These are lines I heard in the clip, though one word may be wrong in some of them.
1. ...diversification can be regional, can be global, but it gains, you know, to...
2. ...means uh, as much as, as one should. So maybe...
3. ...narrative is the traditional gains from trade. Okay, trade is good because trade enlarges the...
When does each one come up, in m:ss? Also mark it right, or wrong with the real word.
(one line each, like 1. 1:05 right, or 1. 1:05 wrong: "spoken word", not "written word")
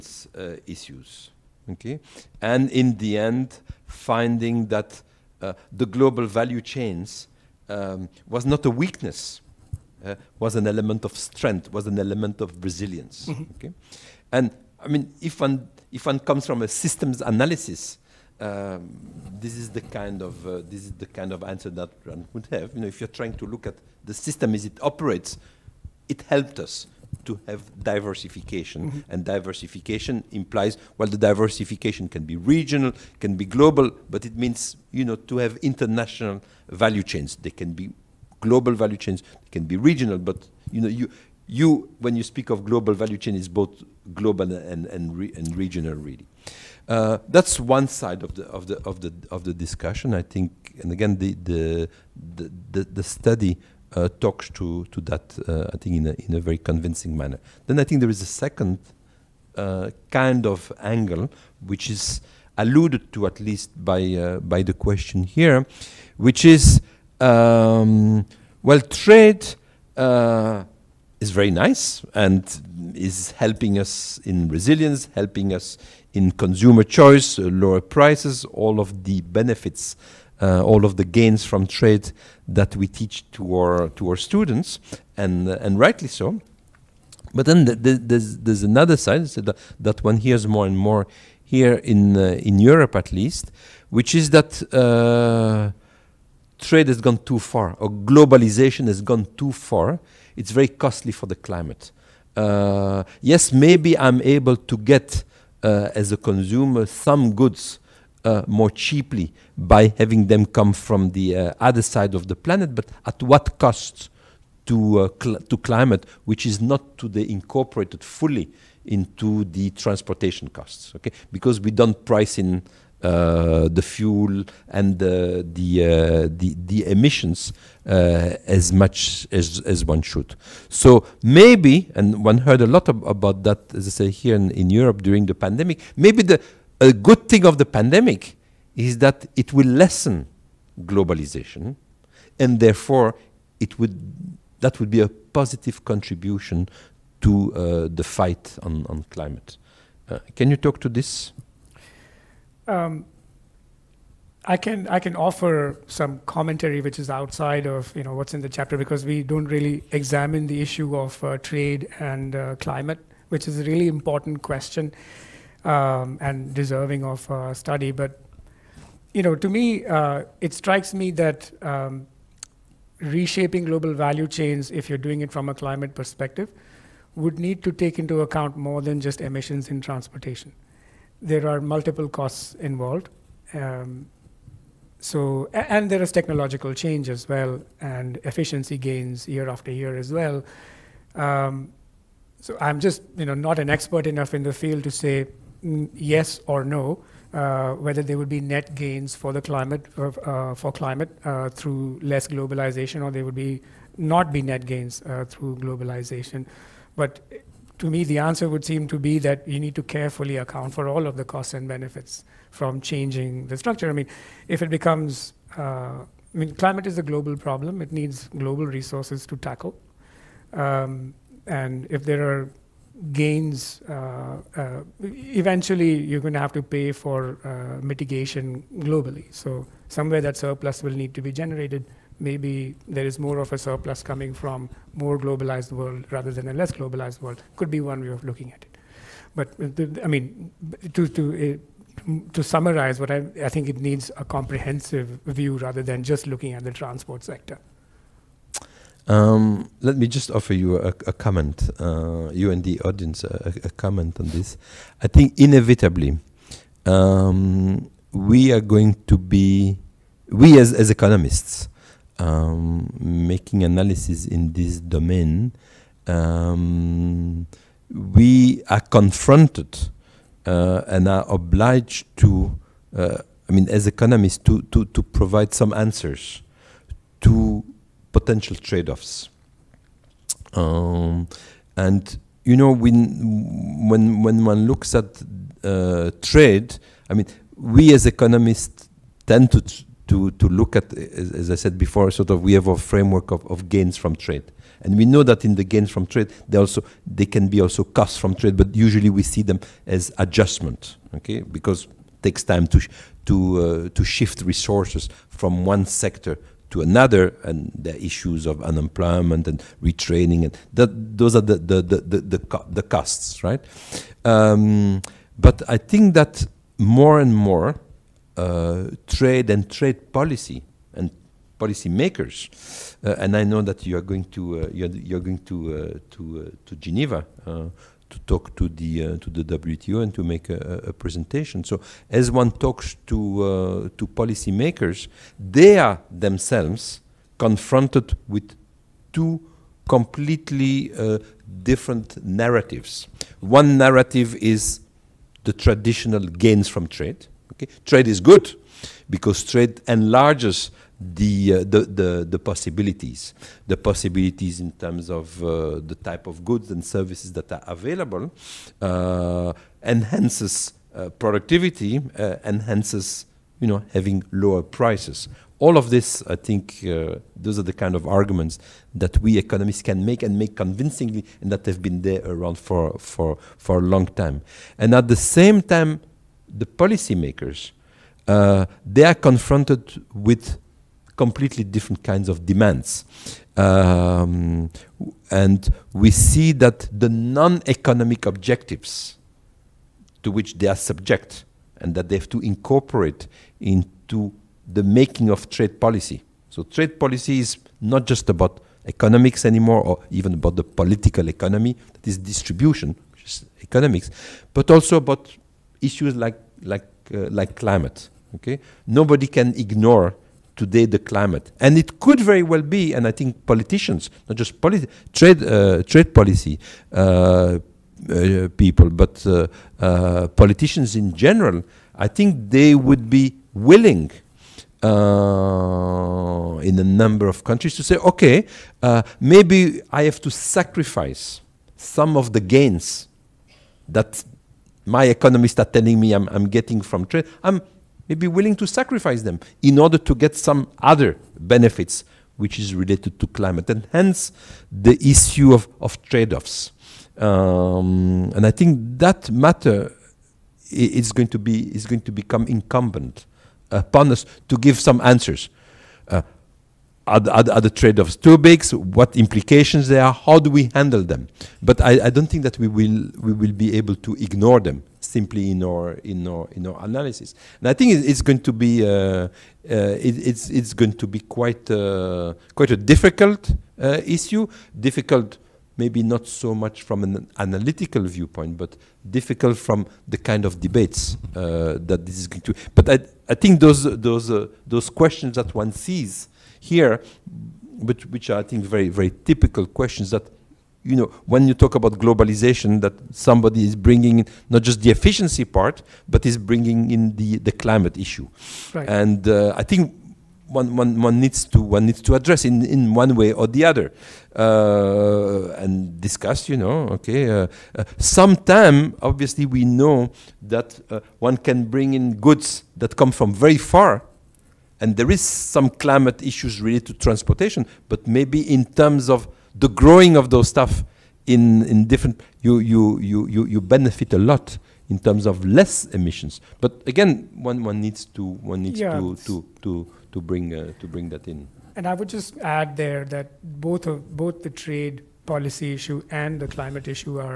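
1. 0:31 wrong: "means", not "gains"
2. 2:06 wrong: "emissions", not "means"
3. 5:43 right.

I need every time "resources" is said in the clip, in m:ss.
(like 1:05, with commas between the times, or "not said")
3:38, 5:04.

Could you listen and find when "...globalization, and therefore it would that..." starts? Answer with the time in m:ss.
2:20.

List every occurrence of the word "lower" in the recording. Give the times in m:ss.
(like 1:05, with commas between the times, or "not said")
1:17, 6:04.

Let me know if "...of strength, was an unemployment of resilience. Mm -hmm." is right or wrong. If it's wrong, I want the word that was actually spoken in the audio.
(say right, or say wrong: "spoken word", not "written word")
wrong: "element", not "unemployment".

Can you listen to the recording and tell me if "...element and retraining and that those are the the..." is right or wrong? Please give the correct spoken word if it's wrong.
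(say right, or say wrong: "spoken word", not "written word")
wrong: "unemployment", not "element".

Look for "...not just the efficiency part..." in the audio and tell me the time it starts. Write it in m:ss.
8:14.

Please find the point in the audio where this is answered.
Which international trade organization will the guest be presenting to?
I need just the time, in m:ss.
5:29.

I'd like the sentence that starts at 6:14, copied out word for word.
And at the same time, the policymakers they are confronted with completely different kinds of demands.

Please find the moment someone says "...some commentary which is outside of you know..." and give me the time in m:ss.
2:35.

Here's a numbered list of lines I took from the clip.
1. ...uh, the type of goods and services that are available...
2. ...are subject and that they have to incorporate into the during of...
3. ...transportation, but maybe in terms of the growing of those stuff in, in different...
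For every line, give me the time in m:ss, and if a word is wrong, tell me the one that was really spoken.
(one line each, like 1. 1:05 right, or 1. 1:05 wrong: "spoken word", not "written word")
1. 5:55 right
2. 6:30 wrong: "making", not "during"
3. 8:36 right.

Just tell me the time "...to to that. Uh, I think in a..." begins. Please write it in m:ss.
0:54.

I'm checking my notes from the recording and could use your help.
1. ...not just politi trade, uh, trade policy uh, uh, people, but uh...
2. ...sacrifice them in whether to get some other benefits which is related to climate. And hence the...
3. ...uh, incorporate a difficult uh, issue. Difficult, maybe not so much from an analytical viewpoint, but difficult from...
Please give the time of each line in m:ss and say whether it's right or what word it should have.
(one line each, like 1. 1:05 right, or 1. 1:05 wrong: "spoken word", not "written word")
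1. 6:54 right
2. 7:18 wrong: "order", not "whether"
3. 7:51 wrong: "quite", not "incorporate".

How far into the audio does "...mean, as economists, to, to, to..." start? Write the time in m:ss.
4:33.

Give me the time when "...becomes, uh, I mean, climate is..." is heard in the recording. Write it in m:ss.
3:34.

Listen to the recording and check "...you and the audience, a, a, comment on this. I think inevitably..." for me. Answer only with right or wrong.
right.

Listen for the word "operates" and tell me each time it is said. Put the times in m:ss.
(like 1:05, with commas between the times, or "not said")
0:24.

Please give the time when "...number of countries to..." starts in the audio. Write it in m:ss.
7:06.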